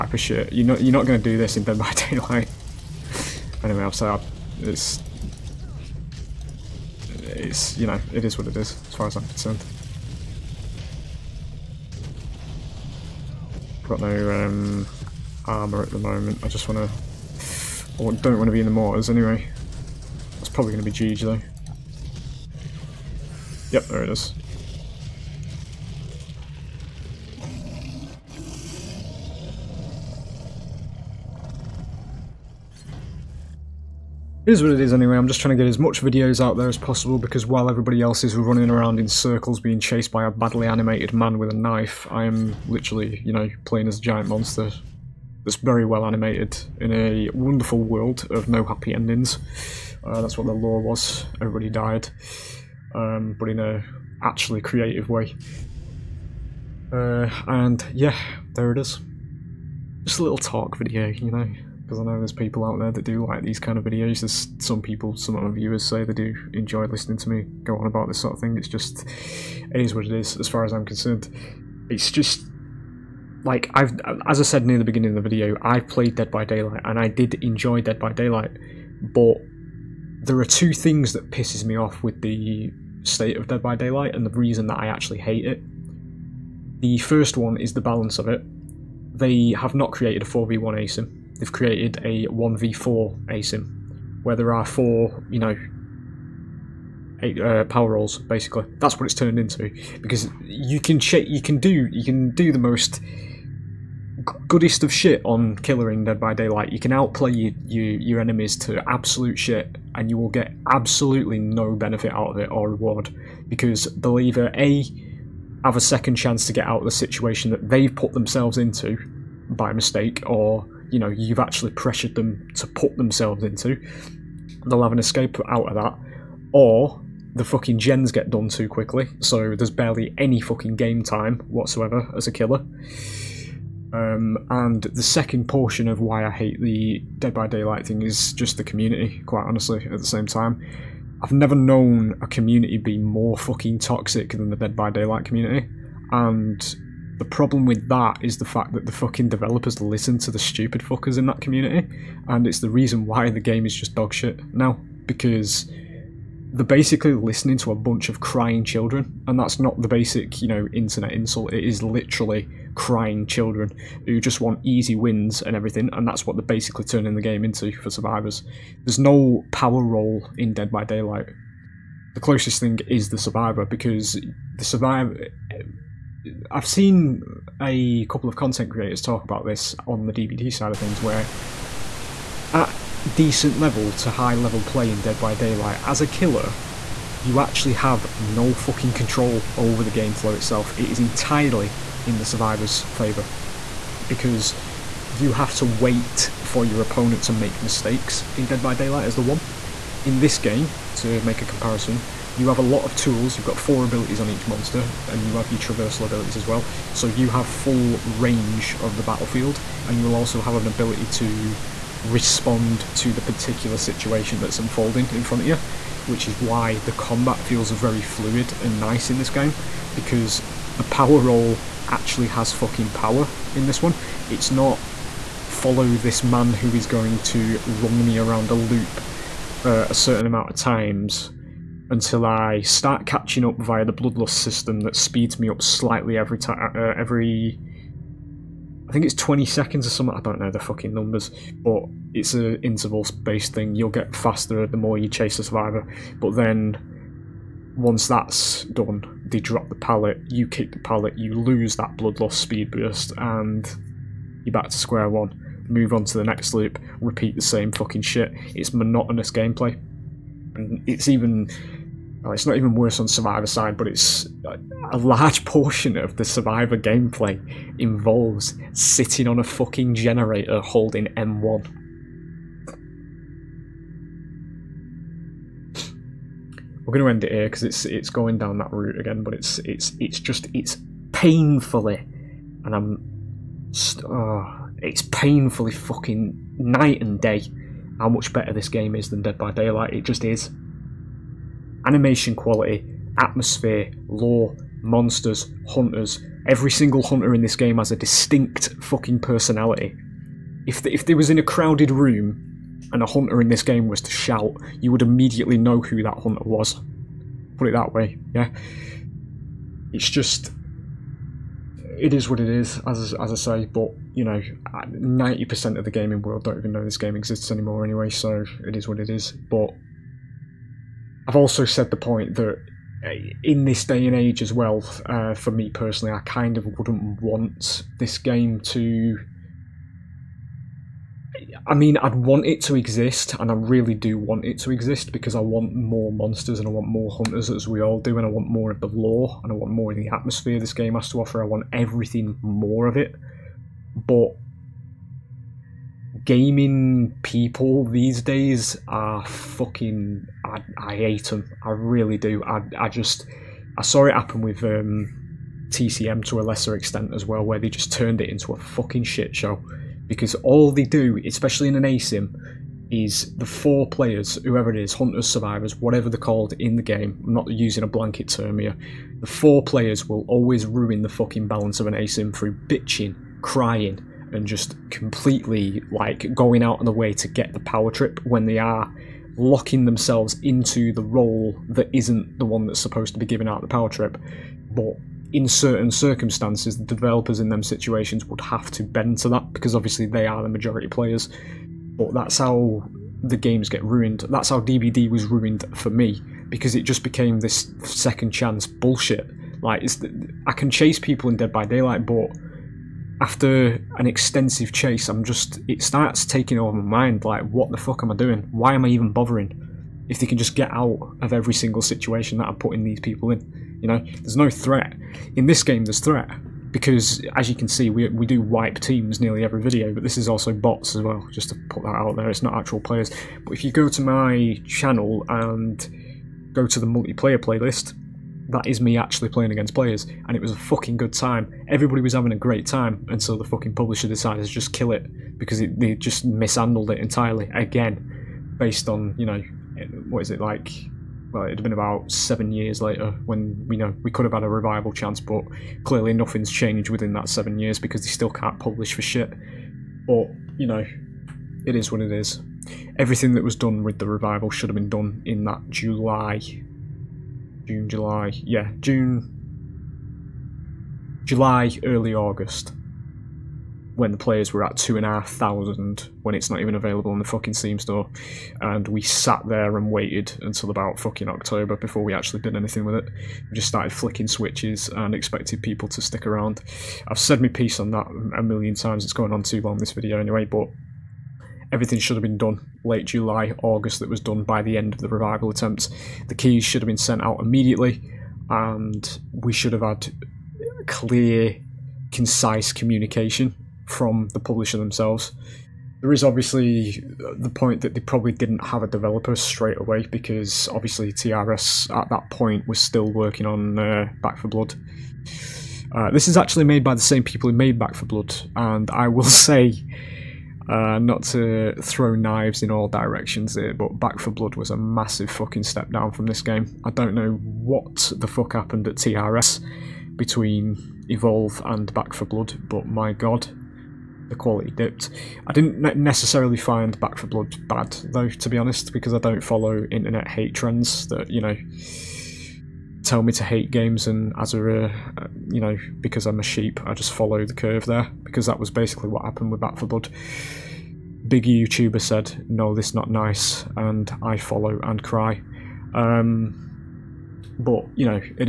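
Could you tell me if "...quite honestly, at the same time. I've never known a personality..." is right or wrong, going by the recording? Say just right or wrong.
wrong.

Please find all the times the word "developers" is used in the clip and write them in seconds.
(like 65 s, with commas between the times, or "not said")
149 s, 386 s, 498 s.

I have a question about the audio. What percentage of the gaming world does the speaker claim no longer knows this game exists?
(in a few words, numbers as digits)
90 percent.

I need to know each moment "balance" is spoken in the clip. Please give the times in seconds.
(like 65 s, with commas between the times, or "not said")
87 s, 371 s.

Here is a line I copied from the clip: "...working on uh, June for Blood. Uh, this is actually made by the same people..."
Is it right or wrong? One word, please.
wrong.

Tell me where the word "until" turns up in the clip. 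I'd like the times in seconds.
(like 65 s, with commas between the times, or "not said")
231 s, 470 s.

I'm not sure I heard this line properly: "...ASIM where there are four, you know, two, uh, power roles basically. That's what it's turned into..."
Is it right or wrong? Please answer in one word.
wrong.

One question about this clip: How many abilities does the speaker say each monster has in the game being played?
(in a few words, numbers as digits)
4.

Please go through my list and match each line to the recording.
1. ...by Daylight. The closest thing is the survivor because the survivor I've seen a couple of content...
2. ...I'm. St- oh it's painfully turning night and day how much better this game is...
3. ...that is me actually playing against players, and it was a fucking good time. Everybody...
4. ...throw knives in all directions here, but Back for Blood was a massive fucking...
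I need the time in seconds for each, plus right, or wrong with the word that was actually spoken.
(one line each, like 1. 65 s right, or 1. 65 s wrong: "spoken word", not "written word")
1. 170 s right
2. 282 s wrong: "fucking", not "turning"
3. 428 s right
4. 511 s right.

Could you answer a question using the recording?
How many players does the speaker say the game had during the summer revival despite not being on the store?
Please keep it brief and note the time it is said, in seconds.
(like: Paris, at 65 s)
2,500, at 464 s.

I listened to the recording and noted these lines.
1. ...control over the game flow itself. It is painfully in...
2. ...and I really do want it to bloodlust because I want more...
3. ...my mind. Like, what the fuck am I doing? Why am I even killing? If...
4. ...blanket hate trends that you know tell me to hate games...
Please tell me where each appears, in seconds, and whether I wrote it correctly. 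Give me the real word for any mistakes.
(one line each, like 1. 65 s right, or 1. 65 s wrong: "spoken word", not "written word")
1. 188 s wrong: "entirely", not "painfully"
2. 333 s wrong: "exist", not "bloodlust"
3. 406 s wrong: "bothering", not "killing"
4. 529 s wrong: "internet", not "blanket".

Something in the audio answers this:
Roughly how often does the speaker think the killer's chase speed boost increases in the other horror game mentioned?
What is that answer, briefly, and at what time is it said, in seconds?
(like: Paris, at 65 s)
20 seconds, at 239 s.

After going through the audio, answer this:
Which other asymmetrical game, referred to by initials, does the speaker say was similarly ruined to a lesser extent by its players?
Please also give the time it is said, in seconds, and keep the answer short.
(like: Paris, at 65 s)
TCM, at 355 s.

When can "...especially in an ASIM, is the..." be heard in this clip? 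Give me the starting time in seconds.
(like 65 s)
361 s.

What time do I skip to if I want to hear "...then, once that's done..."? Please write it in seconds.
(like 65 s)
246 s.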